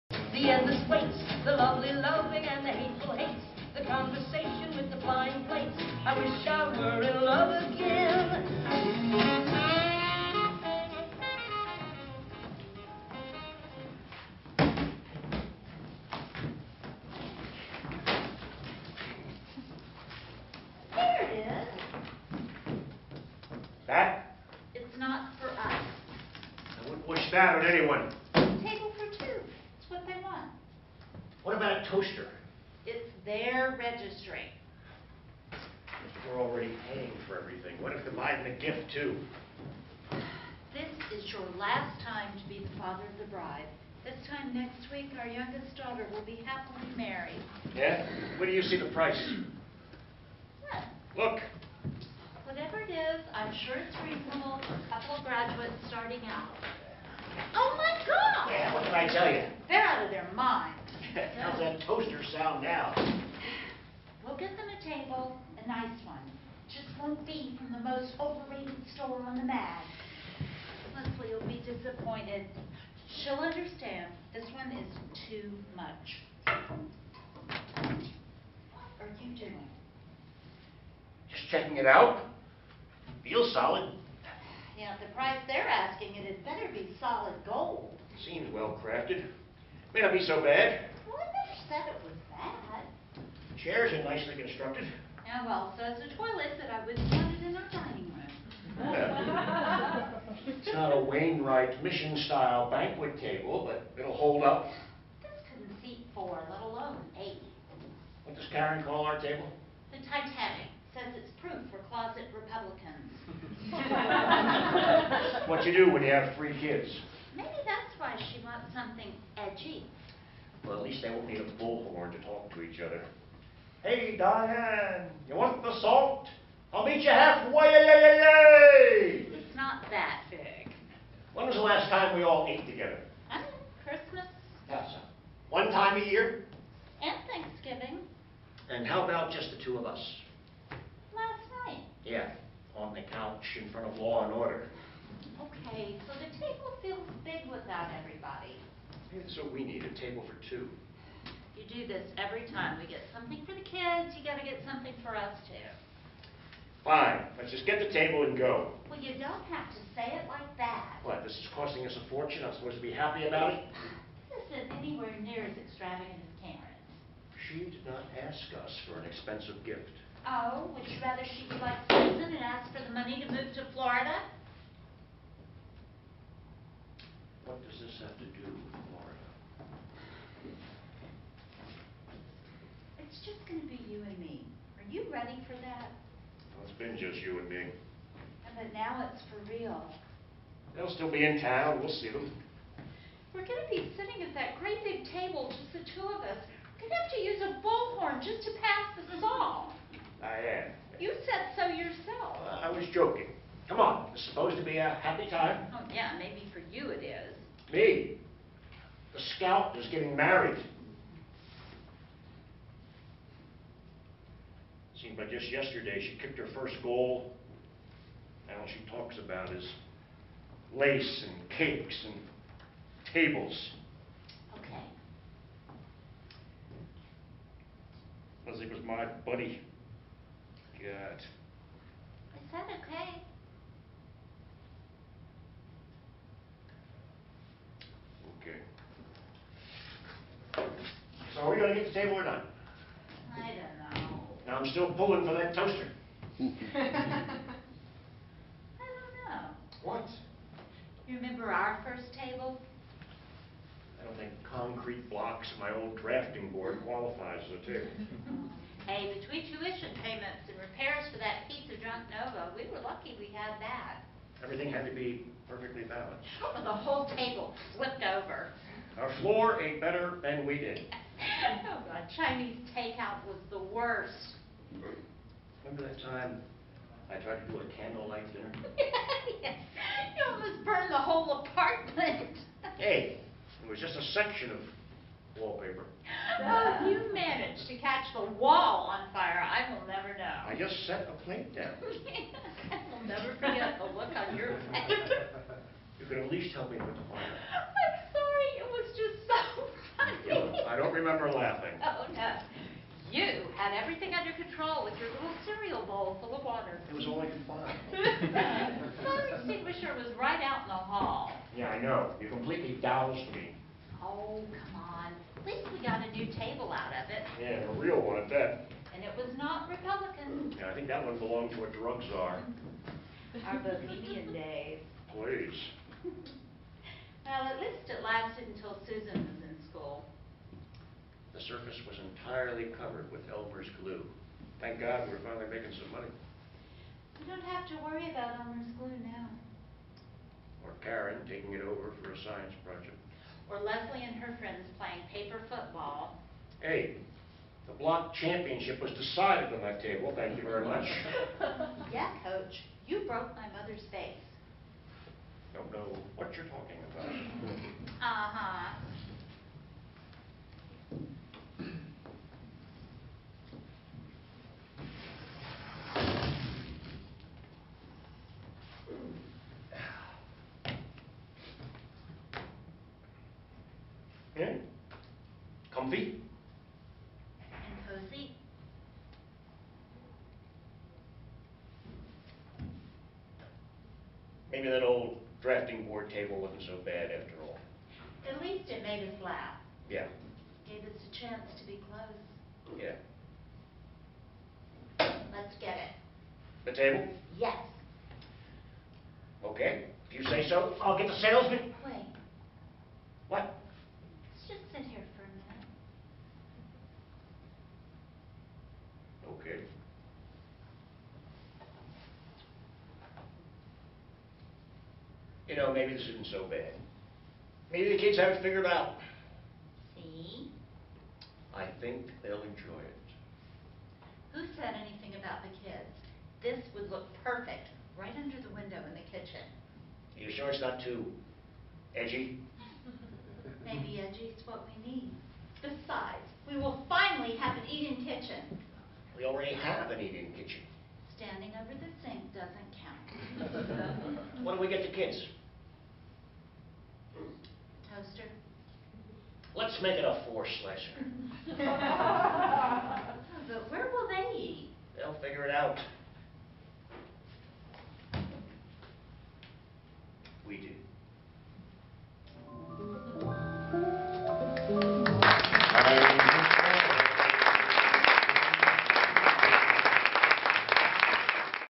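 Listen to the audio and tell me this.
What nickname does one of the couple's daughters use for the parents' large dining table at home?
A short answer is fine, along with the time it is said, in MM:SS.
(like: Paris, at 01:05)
The Titanic, at 01:49.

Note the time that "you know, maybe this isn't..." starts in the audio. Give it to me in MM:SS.
06:55.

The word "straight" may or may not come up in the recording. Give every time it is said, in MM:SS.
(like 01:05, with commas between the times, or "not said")
not said.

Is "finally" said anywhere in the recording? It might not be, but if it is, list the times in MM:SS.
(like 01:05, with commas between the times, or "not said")
05:35, 07:16.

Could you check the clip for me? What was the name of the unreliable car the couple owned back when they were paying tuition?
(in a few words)
Nova.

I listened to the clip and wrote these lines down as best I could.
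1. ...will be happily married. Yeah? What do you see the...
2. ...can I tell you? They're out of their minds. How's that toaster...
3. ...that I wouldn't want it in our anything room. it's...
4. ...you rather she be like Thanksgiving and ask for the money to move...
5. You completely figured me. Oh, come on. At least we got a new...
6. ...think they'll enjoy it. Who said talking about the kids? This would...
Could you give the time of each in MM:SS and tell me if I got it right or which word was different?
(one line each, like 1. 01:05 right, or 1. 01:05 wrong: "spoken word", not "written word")
1. 00:46 right
2. 00:58 right
3. 01:36 wrong: "dining", not "anything"
4. 02:50 wrong: "Susan", not "Thanksgiving"
5. 05:12 wrong: "doused", not "figured"
6. 07:01 wrong: "anything", not "talking".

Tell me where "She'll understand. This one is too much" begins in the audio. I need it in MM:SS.
01:13.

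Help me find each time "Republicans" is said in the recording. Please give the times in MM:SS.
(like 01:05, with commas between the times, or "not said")
01:52, 05:19.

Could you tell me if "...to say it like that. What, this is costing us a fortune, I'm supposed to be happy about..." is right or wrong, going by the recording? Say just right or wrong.
right.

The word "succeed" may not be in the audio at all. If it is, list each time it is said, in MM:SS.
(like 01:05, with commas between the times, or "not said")
not said.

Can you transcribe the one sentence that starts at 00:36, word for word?
we're already paying for everything, what if they're buying the gift too?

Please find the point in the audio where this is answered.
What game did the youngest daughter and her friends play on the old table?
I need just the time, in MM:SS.
05:45.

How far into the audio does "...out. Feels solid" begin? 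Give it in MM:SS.
01:21.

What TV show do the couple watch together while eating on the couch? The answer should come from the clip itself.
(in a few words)
Law and Order.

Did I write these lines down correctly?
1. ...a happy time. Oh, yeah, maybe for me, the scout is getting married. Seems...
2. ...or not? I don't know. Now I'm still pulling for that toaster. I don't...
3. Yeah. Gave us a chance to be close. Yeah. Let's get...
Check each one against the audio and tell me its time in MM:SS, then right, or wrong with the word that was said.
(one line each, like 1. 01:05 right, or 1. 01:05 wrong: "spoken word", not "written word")
1. 03:24 right
2. 04:02 right
3. 06:29 right.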